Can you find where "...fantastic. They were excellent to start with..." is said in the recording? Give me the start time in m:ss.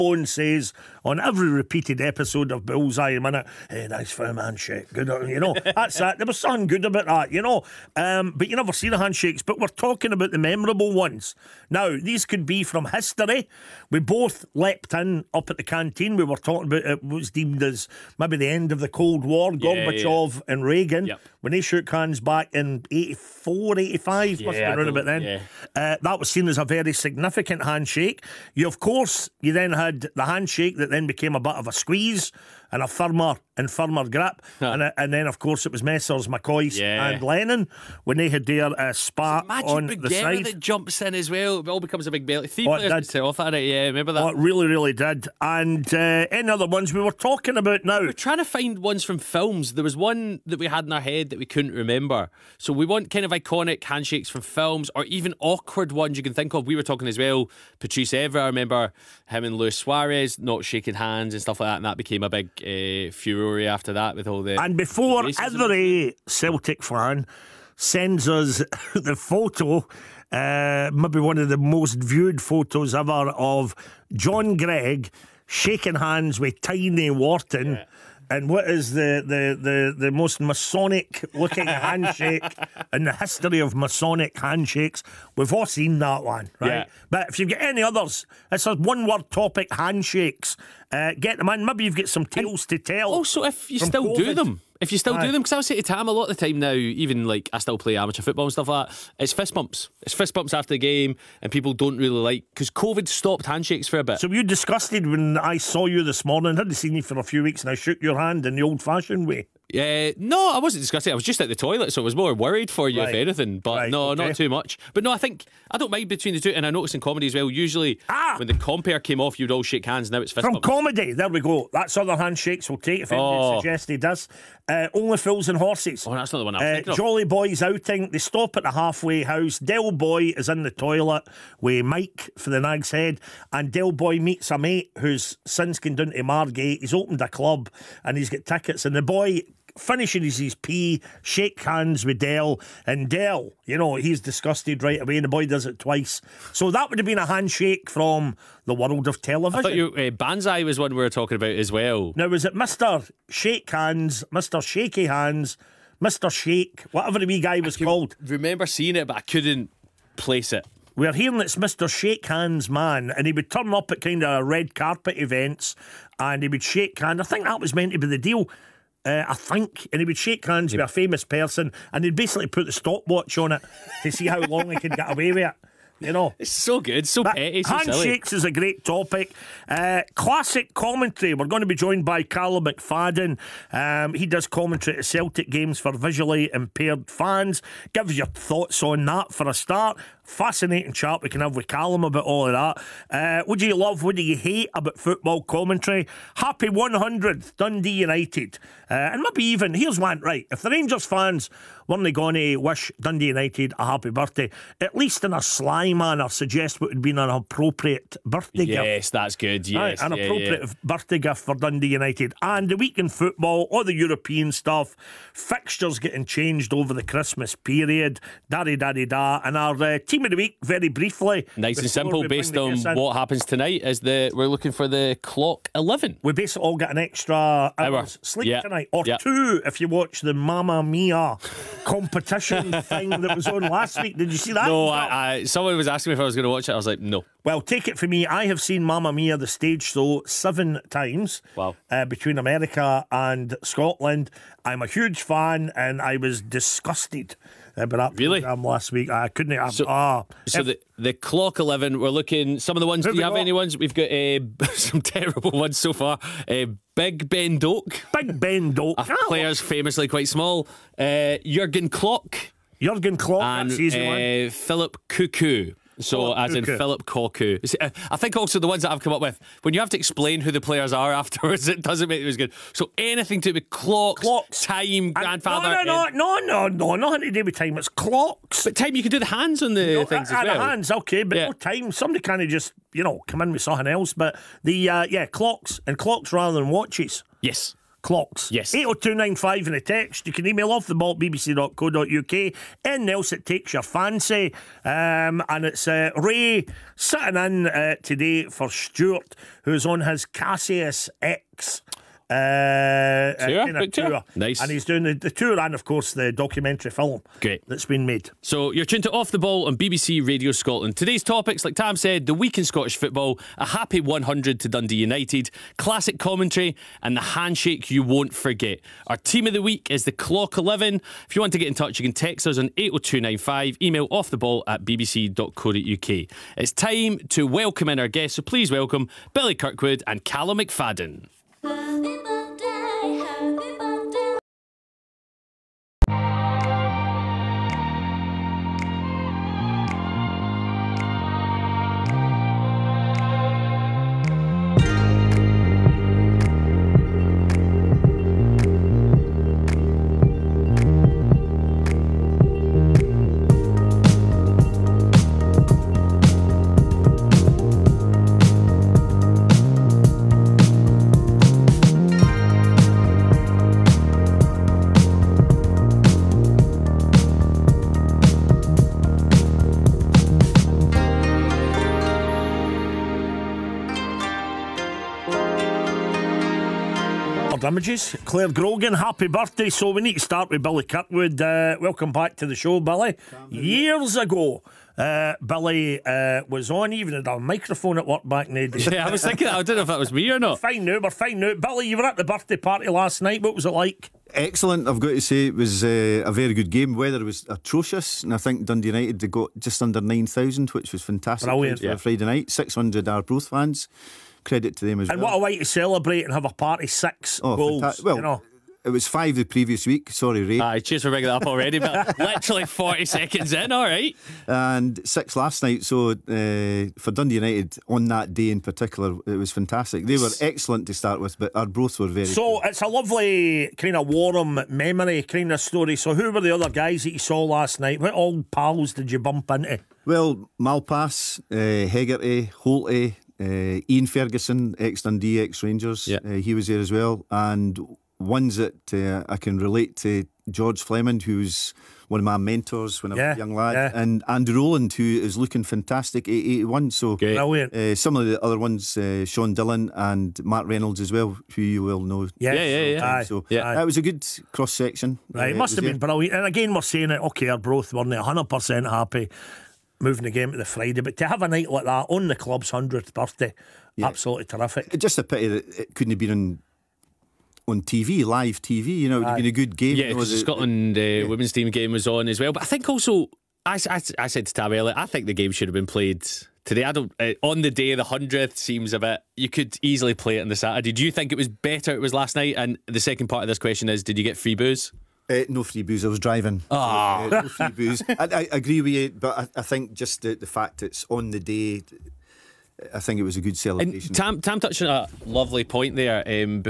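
6:59.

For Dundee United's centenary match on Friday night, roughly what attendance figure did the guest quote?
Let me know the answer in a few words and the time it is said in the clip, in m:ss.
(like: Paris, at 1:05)
just under 9,000, at 6:39.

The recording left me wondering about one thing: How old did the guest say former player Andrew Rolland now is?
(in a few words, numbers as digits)
81.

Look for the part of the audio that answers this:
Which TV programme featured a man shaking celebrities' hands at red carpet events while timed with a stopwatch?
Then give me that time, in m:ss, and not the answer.
2:30.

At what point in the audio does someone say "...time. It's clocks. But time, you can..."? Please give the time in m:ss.
4:37.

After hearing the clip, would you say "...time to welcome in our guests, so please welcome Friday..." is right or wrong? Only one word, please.
wrong.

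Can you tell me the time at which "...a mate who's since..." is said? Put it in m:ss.
2:14.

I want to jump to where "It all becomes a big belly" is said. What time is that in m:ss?
0:41.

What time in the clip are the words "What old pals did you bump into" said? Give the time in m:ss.
7:07.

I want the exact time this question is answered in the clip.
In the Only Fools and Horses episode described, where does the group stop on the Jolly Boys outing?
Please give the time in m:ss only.
2:08.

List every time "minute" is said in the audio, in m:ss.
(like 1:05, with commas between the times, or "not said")
0:03.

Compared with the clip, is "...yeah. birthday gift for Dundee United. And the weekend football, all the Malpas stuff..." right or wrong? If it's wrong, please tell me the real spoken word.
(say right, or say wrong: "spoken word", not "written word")
wrong: "European", not "Malpas".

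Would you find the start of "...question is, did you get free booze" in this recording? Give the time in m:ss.
8:03.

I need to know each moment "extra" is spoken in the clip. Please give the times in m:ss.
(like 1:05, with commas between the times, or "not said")
3:46.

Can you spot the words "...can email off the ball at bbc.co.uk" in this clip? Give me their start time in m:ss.
4:50.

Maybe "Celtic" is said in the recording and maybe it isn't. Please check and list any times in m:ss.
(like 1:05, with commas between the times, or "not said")
1:06, 3:05.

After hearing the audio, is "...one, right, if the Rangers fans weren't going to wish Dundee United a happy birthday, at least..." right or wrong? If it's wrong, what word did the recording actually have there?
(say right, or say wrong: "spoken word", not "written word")
right.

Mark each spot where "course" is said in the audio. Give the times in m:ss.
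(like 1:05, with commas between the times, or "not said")
0:28, 0:35, 5:05.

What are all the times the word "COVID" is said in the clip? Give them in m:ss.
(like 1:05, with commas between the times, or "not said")
1:34, 1:42.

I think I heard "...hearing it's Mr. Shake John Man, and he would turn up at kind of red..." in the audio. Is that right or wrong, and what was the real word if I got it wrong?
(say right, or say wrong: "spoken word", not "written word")
wrong: "Hands", not "John".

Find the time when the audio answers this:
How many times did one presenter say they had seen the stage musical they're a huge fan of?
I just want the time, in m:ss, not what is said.
4:00.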